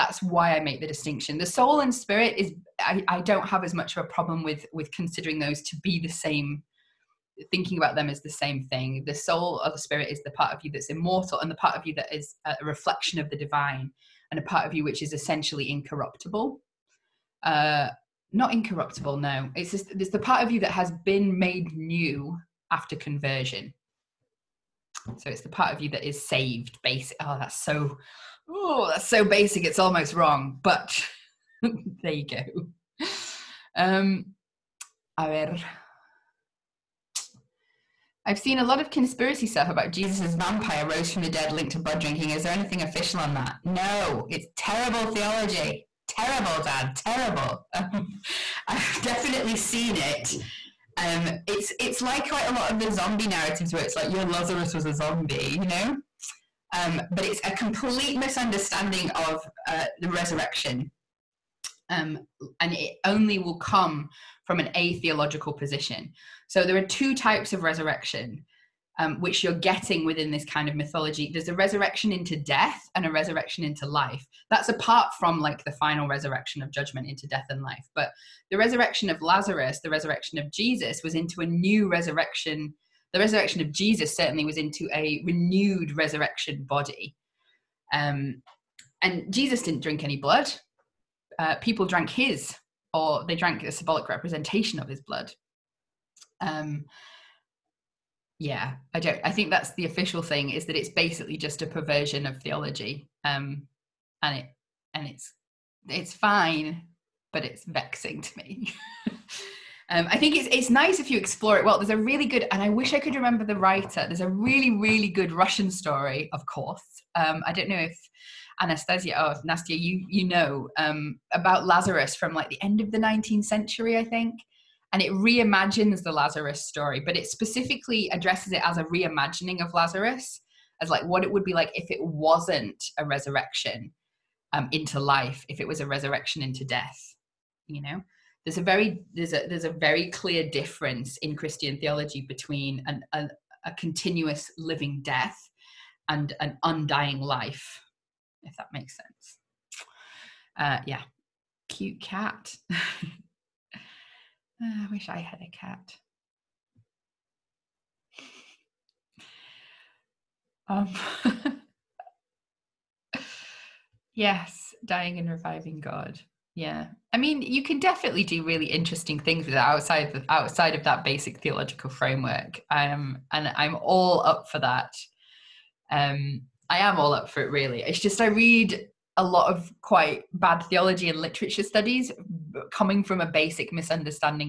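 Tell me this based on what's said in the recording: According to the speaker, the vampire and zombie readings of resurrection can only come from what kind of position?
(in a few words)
An atheological position.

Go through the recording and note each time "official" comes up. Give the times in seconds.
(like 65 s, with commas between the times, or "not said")
42 s, 99 s.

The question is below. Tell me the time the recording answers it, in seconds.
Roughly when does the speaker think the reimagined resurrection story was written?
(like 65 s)
122 s.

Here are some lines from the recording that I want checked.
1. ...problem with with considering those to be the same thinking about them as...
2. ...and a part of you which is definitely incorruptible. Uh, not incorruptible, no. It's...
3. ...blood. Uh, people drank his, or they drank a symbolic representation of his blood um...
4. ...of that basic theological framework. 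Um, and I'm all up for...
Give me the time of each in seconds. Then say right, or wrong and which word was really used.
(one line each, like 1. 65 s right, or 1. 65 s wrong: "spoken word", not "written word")
1. 4 s right
2. 14 s wrong: "essentially", not "definitely"
3. 90 s right
4. 170 s right.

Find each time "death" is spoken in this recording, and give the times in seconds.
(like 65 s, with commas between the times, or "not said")
72 s, 77 s, 136 s, 145 s.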